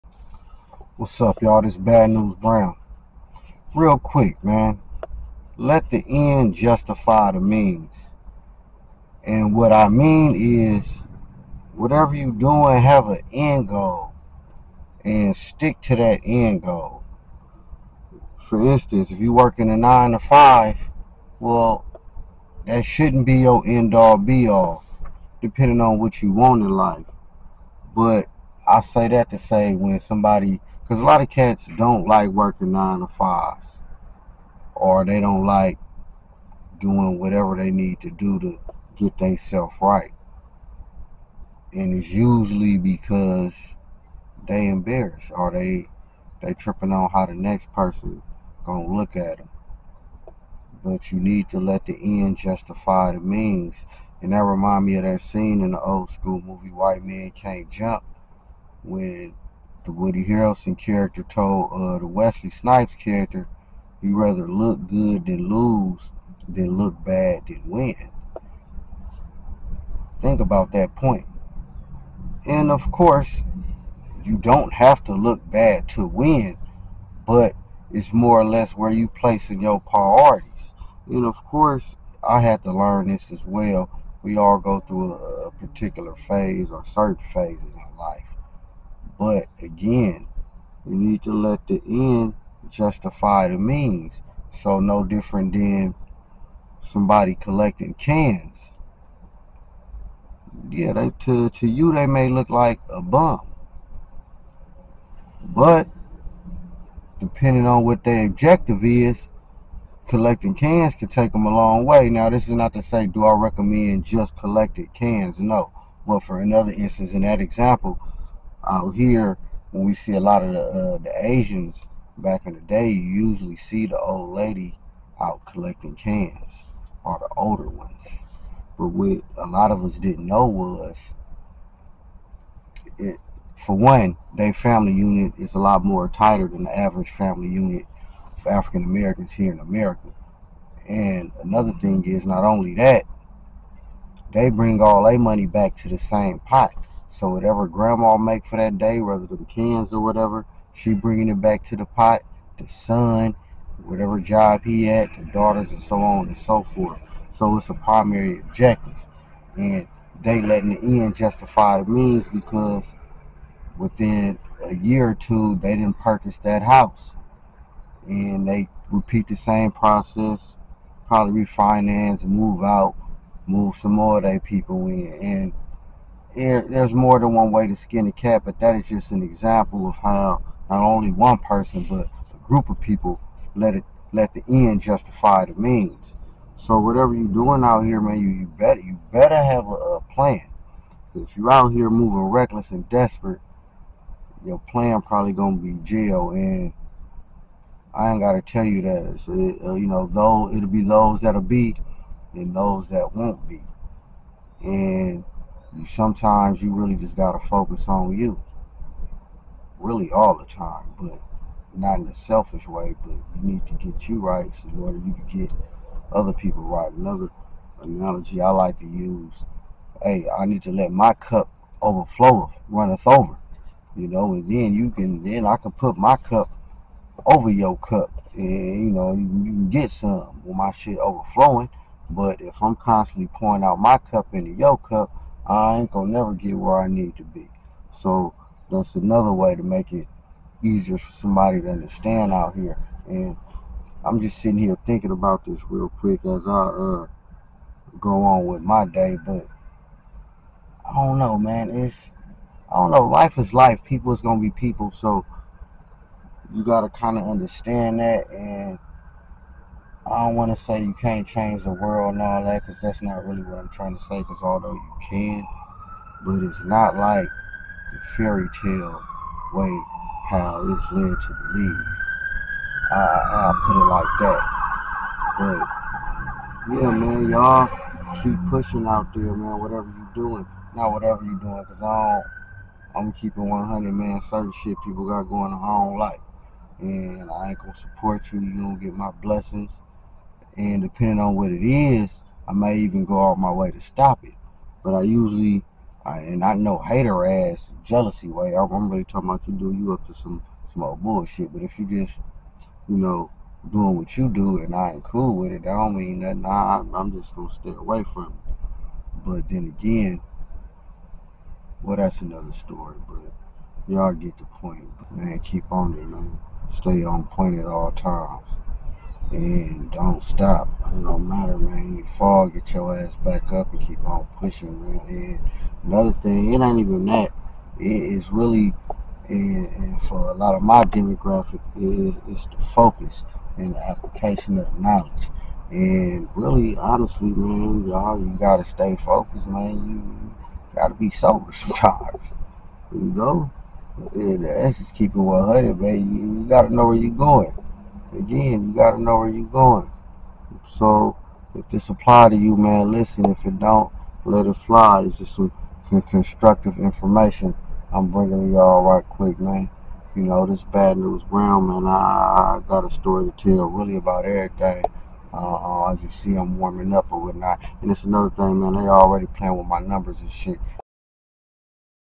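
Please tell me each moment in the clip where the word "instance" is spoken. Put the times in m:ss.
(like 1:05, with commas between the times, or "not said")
0:18, 1:56.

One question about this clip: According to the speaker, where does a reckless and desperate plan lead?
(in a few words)
Jail.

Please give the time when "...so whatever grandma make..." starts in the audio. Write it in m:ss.
2:27.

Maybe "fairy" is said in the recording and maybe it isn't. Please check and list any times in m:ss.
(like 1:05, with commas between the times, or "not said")
4:28.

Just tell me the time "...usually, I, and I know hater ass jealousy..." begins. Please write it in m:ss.
4:55.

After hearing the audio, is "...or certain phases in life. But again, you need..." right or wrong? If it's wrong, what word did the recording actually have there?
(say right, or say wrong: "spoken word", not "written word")
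right.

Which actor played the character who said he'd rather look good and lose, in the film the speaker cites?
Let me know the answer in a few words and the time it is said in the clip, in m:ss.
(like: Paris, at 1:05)
Woody Harrelson, at 0:59.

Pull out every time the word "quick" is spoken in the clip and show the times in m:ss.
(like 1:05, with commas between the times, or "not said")
0:03, 4:05, 5:59.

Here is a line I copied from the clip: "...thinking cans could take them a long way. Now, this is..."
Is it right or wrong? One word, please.
wrong.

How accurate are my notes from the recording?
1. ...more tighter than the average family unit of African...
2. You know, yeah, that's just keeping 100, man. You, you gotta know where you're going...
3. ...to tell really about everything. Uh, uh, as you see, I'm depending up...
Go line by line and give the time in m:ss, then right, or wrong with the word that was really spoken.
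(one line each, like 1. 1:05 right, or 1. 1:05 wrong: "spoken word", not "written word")
1. 2:15 right
2. 5:42 right
3. 6:03 wrong: "warming", not "depending".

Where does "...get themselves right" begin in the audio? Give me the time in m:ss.
0:38.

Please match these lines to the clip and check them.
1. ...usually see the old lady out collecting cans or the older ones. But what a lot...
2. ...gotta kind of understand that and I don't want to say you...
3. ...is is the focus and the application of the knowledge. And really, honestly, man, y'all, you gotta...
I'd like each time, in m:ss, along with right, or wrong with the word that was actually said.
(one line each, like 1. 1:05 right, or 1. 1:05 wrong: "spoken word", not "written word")
1. 2:03 right
2. 4:16 right
3. 5:31 right.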